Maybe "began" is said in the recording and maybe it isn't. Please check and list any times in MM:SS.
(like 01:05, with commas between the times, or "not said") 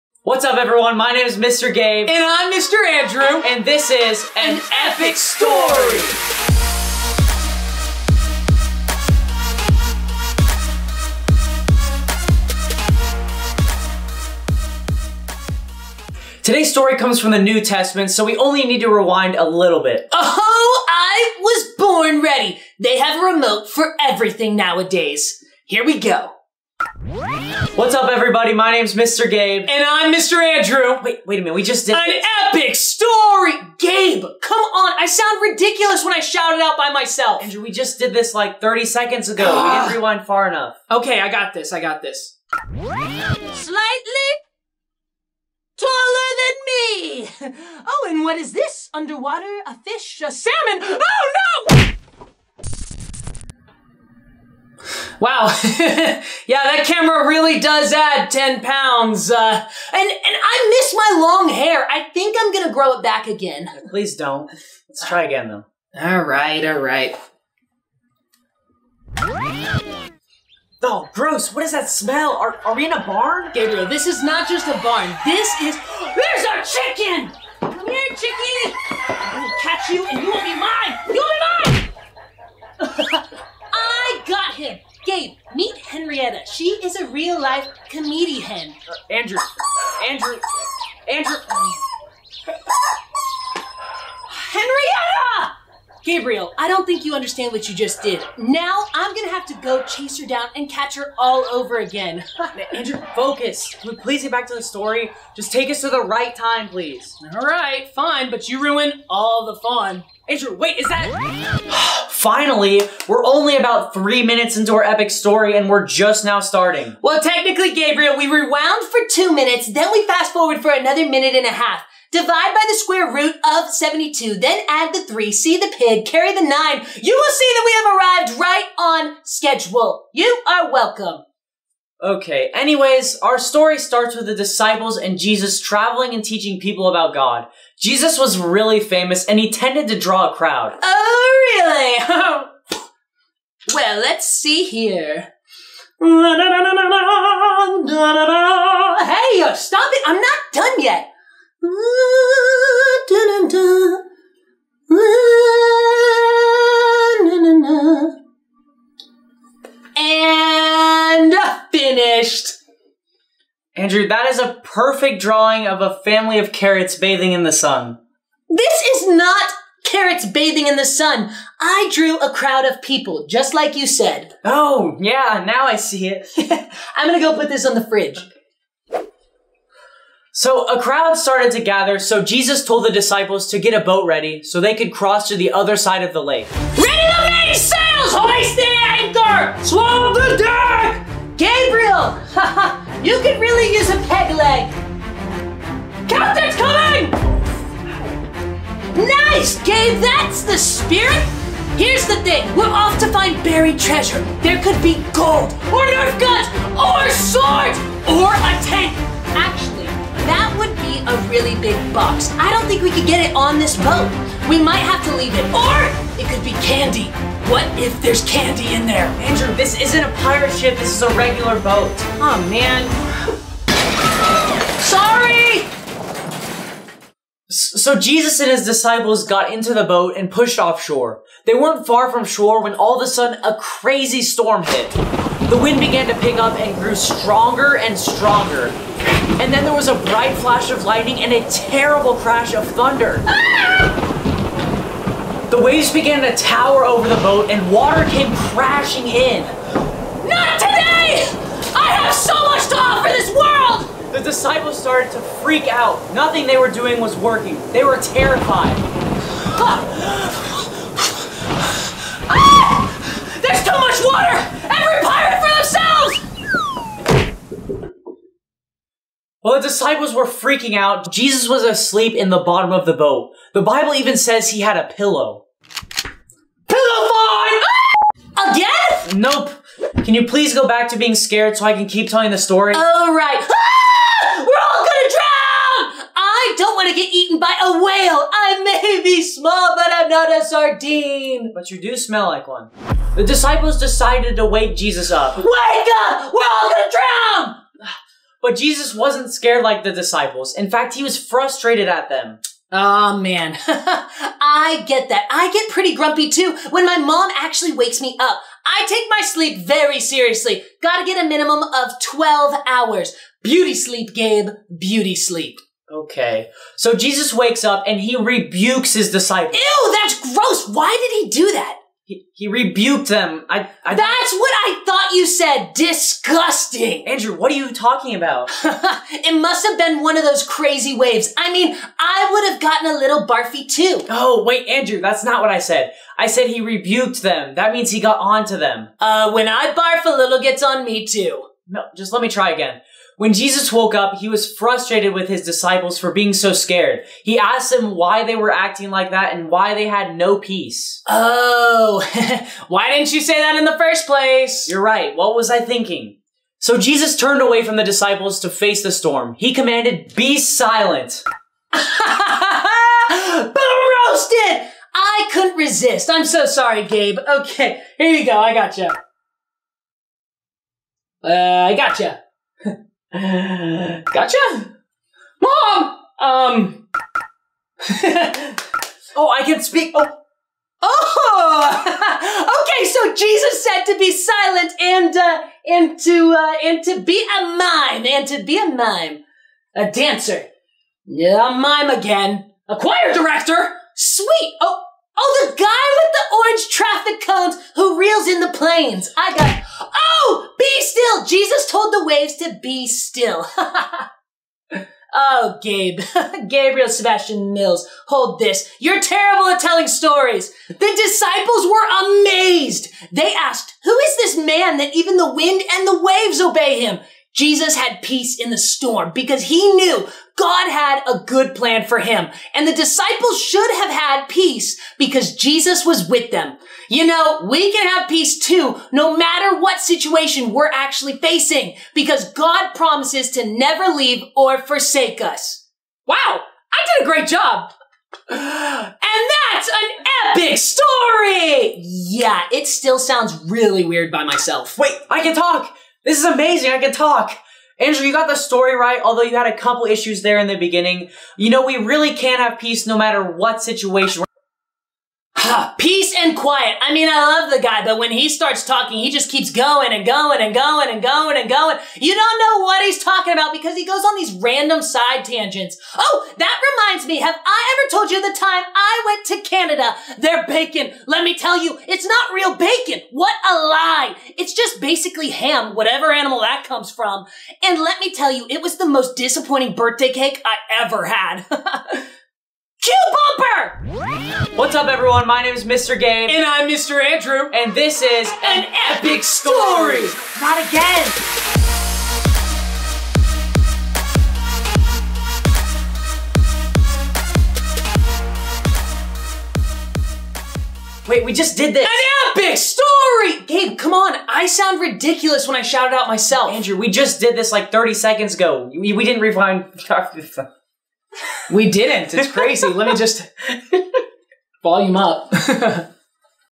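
03:55, 04:05.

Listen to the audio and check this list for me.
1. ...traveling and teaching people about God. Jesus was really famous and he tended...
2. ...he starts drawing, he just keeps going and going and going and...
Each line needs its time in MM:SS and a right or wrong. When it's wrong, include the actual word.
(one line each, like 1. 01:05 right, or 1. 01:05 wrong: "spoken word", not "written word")
1. 02:15 right
2. 07:38 wrong: "talking", not "drawing".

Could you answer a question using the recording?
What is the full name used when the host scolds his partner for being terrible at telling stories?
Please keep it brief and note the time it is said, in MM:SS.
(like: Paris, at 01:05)
Gabriel Sebastian Mills, at 06:46.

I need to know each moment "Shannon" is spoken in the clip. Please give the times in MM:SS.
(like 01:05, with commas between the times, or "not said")
not said.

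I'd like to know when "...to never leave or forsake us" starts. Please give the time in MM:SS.
07:13.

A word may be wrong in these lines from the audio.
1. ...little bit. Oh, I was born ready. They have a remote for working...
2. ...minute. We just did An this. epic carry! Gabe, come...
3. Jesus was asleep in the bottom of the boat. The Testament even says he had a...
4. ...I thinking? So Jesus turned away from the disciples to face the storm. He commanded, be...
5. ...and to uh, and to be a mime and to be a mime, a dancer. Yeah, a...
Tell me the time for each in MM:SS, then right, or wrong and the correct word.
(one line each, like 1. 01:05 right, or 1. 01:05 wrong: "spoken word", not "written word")
1. 00:19 wrong: "everything", not "working"
2. 00:31 wrong: "story", not "carry"
3. 04:31 wrong: "Bible", not "Testament"
4. 05:55 right
5. 06:25 right.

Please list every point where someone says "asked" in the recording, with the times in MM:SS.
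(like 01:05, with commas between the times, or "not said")
05:47, 06:53.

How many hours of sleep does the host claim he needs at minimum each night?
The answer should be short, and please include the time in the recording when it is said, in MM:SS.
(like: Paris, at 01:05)
12, at 05:12.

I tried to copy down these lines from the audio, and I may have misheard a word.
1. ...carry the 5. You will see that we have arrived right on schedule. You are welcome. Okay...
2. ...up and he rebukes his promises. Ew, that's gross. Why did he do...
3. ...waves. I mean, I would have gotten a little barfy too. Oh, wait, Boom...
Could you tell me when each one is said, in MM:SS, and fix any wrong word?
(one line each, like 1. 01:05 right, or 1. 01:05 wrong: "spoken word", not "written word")
1. 02:06 wrong: "9", not "5"
2. 05:17 wrong: "disciples", not "promises"
3. 05:30 wrong: "Andrew", not "Boom".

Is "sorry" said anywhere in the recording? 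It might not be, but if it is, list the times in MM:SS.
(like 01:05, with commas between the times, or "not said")
03:44, 06:06.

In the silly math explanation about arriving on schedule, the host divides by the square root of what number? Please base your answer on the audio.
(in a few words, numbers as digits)
72.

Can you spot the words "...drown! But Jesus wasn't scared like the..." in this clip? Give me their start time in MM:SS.
04:56.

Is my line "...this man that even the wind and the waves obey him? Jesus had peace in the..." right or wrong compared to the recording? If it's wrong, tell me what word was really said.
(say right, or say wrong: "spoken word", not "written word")
right.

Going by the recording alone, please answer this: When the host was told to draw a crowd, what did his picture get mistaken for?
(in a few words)
A family of carrots bathing in the sun.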